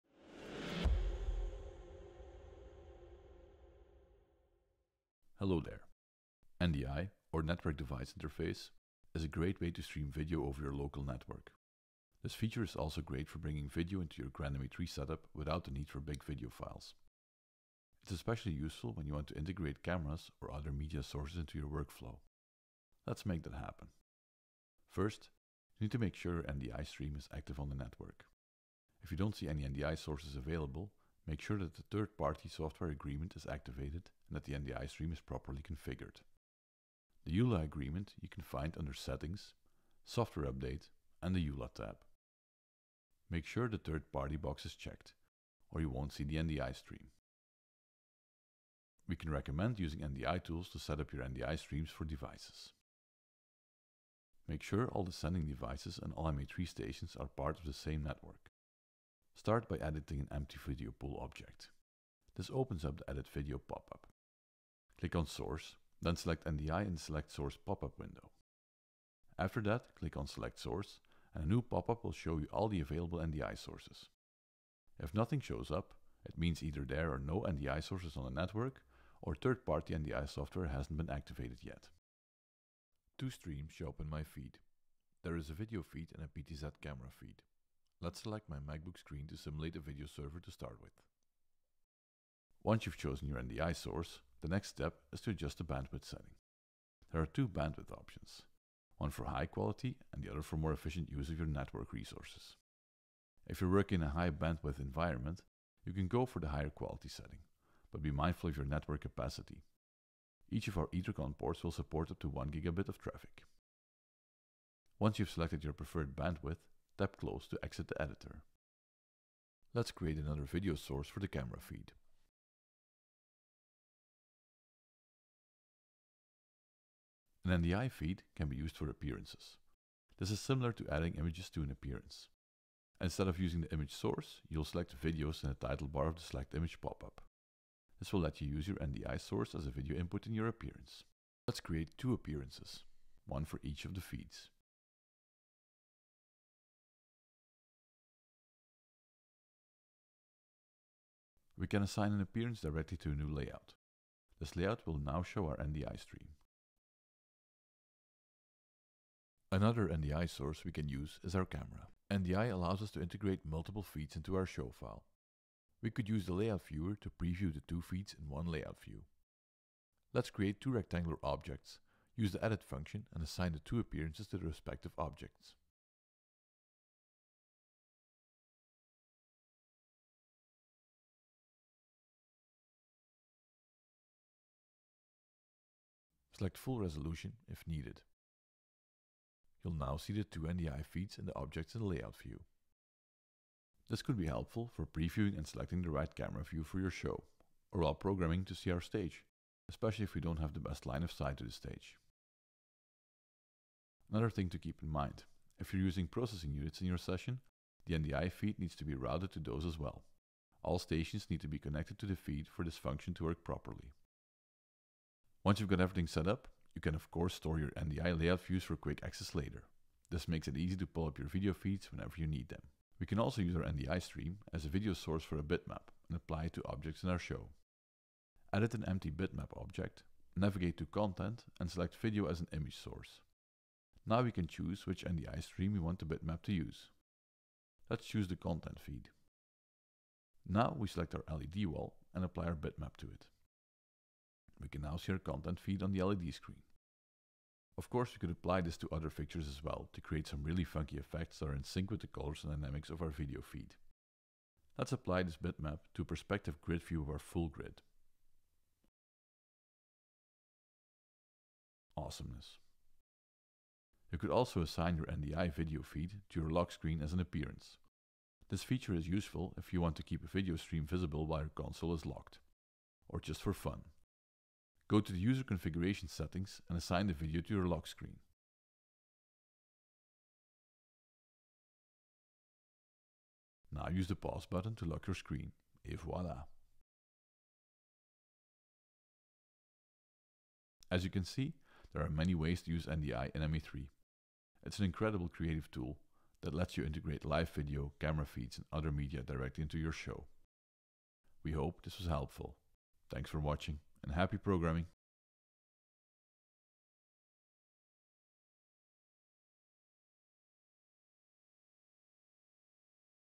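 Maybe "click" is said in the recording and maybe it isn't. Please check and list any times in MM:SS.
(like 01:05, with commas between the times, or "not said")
01:04, 01:09.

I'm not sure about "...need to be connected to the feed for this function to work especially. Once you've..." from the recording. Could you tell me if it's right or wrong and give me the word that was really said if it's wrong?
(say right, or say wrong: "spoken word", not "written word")
wrong: "properly", not "especially".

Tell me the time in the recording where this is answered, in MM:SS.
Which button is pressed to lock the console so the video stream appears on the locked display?
04:44.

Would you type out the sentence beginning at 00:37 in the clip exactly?
The EULA agreement you can find under Settings, Software Update and the EULA tab.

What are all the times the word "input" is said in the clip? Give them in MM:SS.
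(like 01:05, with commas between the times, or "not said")
02:19.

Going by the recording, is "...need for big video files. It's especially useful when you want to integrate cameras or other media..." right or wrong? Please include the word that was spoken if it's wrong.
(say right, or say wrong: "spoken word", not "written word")
right.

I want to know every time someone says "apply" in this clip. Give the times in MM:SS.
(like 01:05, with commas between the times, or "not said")
03:46, 04:02, 04:08, 04:14.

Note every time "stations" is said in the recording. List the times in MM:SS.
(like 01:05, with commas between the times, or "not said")
00:56, 03:30.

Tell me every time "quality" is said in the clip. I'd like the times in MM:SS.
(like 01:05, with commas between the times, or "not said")
01:39, 01:46.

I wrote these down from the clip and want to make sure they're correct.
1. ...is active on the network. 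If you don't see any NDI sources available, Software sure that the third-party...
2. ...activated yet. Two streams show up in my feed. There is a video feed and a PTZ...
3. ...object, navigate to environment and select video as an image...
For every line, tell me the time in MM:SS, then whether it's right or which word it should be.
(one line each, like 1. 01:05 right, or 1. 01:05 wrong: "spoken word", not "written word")
1. 00:27 wrong: "Make", not "Software"
2. 01:21 right
3. 03:49 wrong: "content", not "environment".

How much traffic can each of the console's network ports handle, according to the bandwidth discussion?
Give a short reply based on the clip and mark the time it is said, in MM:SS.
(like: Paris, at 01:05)
1 gigabit, at 01:52.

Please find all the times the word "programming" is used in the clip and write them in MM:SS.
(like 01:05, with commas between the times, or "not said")
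03:17, 05:04.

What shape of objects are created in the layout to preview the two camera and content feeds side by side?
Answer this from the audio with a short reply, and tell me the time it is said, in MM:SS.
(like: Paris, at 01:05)
Rectangular, at 02:50.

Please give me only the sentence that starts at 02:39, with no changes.
Another NDI source we can use is our camera.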